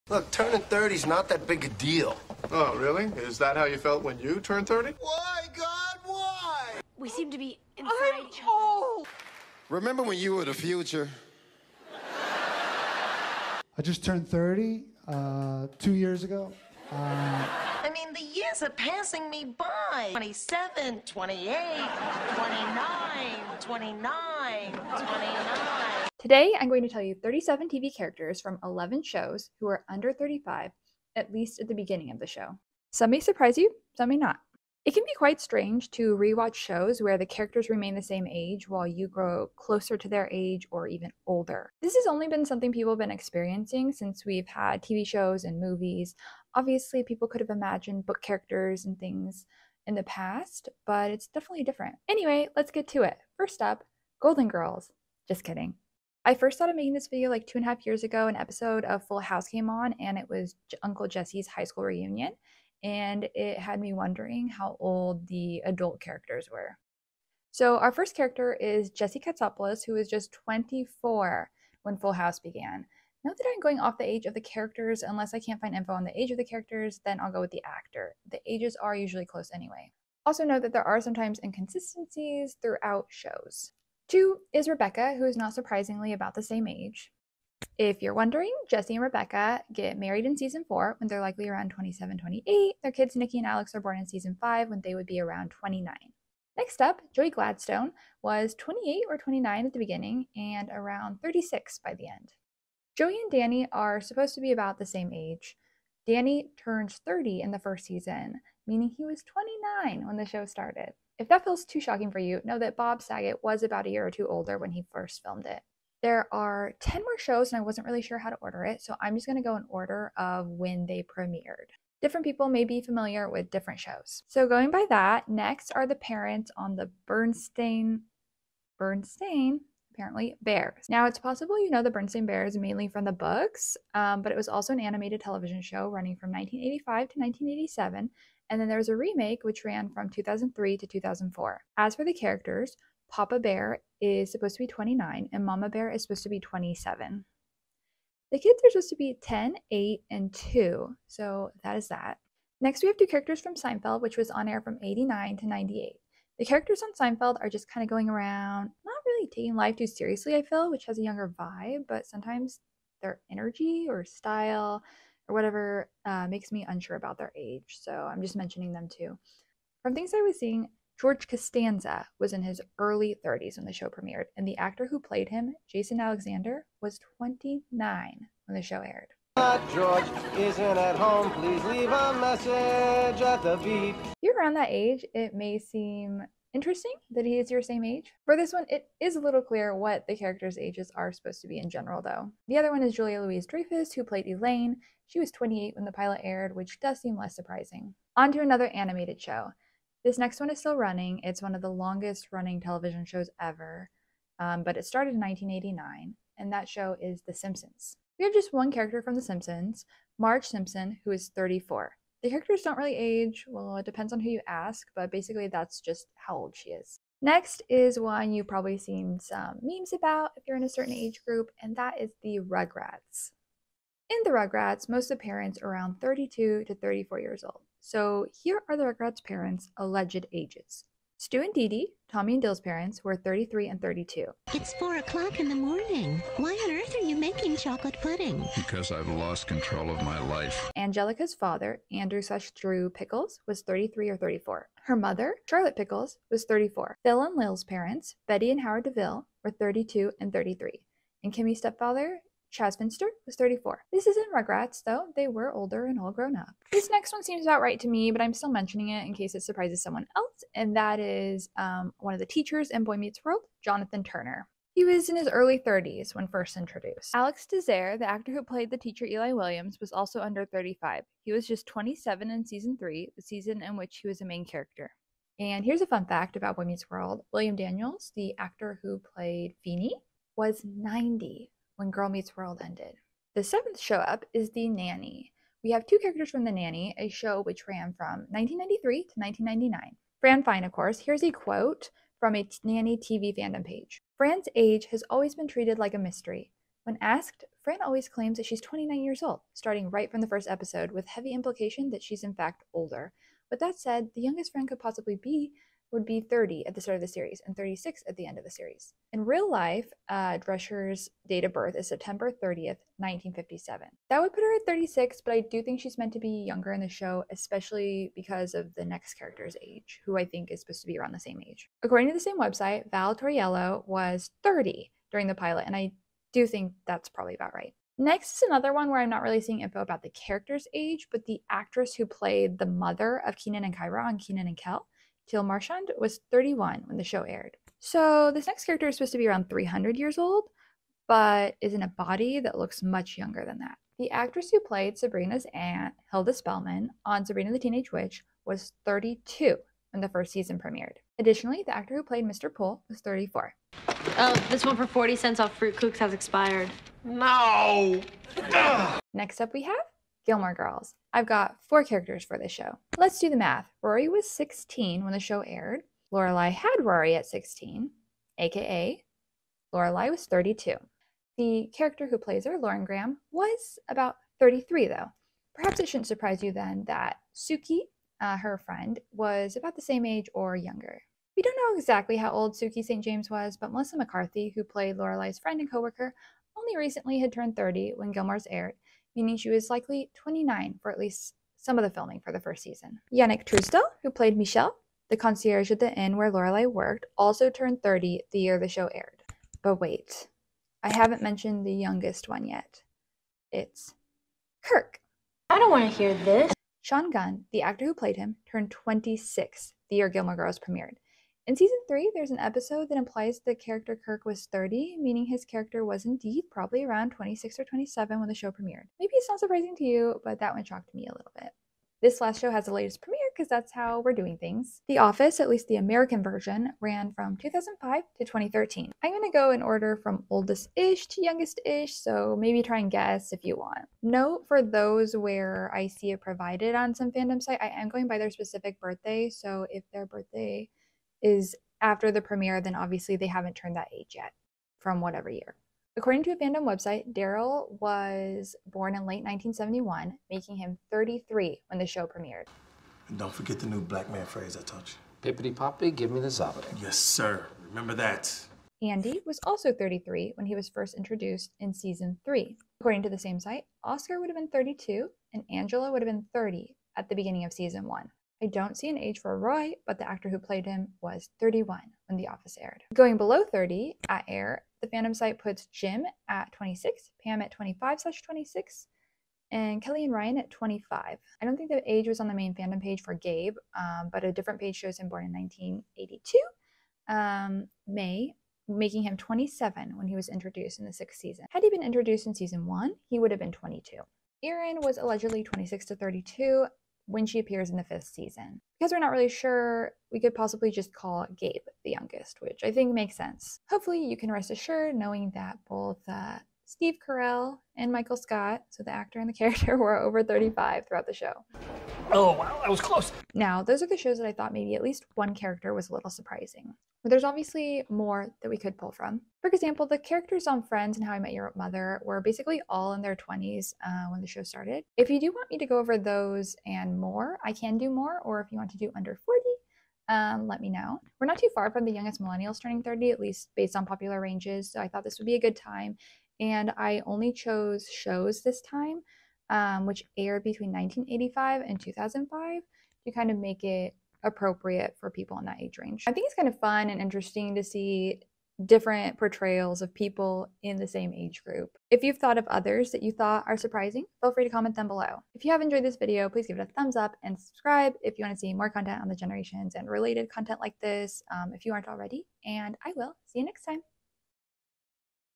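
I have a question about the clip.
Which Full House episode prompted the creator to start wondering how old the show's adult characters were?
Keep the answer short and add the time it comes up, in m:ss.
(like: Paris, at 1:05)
Uncle Jesse's high school reunion, at 1:00.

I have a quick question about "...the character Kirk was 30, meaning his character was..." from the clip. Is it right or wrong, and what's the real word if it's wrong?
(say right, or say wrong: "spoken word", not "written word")
right.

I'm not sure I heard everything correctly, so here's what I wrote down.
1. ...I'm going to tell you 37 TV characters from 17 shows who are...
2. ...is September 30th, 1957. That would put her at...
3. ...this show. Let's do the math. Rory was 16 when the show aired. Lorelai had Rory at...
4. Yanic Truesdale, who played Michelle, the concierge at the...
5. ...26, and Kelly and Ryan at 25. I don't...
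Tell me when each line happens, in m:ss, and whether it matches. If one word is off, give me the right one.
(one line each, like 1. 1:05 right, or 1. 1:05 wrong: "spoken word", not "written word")
1. 0:26 wrong: "11", not "17"
2. 5:11 right
3. 6:02 right
4. 6:33 right
5. 7:58 right.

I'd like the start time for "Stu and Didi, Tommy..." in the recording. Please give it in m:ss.
3:51.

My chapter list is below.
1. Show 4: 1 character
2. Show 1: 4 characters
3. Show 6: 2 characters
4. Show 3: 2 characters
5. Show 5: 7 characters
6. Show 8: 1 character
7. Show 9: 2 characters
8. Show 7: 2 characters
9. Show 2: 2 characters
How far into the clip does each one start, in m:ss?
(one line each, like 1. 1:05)
1. 3:20
2. 1:00
3. 4:17
4. 2:33
5. 3:38
6. 5:28
7. 5:38
8. 4:43
9. 2:05.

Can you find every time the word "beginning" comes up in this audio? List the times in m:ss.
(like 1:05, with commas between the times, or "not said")
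0:31, 1:39, 7:47.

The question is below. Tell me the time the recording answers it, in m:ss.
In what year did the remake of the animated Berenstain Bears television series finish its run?
2:20.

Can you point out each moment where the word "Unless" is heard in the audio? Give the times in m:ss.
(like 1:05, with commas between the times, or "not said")
1:15.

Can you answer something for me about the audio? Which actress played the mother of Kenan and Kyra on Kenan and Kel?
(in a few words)
Jill Marchand.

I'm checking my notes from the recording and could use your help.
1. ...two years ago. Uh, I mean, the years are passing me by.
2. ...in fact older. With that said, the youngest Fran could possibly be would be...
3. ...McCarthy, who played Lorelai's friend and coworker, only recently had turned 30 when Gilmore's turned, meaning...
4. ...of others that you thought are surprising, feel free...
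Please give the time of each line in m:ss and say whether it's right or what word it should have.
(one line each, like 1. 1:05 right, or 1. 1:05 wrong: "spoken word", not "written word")
1. 0:15 right
2. 5:02 right
3. 6:23 wrong: "aired", not "turned"
4. 9:12 right.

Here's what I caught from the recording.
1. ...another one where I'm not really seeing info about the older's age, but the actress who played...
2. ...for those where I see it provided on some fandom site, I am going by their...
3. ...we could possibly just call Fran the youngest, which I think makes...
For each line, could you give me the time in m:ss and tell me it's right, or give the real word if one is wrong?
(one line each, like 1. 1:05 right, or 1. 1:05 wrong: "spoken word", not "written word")
1. 5:28 wrong: "character", not "older"
2. 7:14 right
3. 8:20 wrong: "Gabe", not "Fran".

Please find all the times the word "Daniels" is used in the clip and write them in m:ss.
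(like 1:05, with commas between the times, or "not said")
4:37.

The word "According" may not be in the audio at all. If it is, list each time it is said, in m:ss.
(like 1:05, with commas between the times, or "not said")
5:21, 7:25, 7:42.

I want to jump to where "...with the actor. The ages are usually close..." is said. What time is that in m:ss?
1:17.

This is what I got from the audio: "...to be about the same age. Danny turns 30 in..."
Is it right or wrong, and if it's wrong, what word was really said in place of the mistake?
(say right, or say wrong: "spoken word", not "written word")
right.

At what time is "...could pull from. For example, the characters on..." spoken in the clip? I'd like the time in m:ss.
8:38.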